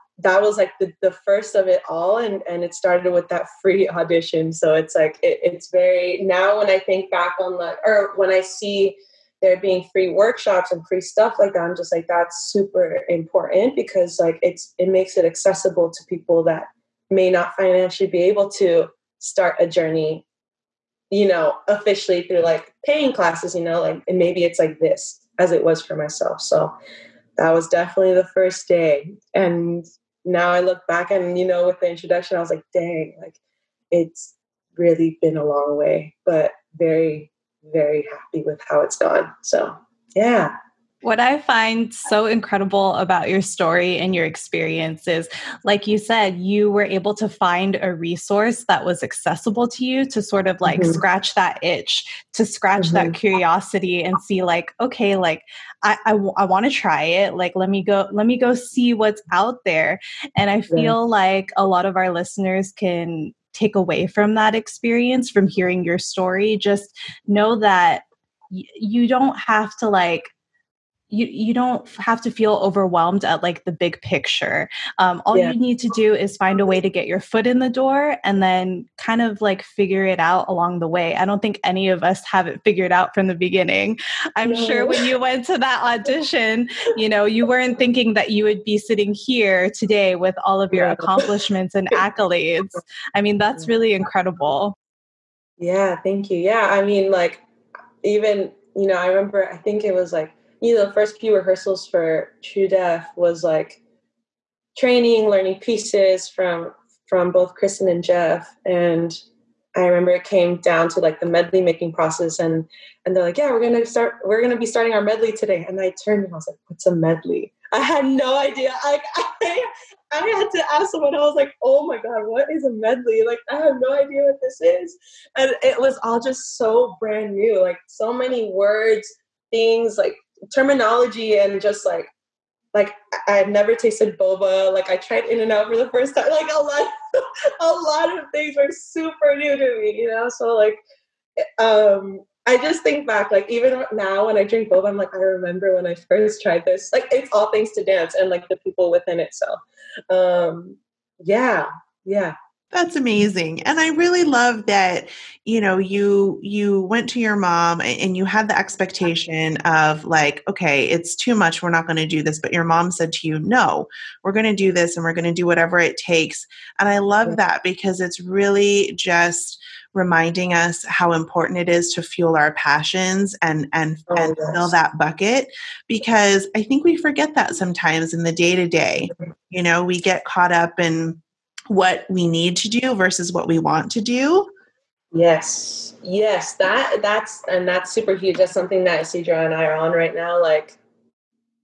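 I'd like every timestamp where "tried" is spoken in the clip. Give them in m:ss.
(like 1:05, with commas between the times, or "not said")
2:14, 2:26.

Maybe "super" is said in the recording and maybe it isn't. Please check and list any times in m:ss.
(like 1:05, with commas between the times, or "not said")
0:12, 2:18, 3:07.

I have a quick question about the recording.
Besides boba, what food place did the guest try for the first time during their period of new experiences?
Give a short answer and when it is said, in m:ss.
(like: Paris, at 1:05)
In and Out, at 2:15.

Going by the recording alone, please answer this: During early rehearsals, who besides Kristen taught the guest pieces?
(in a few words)
Jeff.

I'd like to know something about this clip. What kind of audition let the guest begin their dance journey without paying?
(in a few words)
Free audition.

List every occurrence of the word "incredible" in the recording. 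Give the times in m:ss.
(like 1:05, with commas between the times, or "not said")
0:42, 1:33.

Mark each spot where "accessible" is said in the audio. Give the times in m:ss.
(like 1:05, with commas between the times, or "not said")
0:15, 0:49.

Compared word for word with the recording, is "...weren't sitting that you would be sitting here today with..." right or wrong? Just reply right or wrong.
wrong.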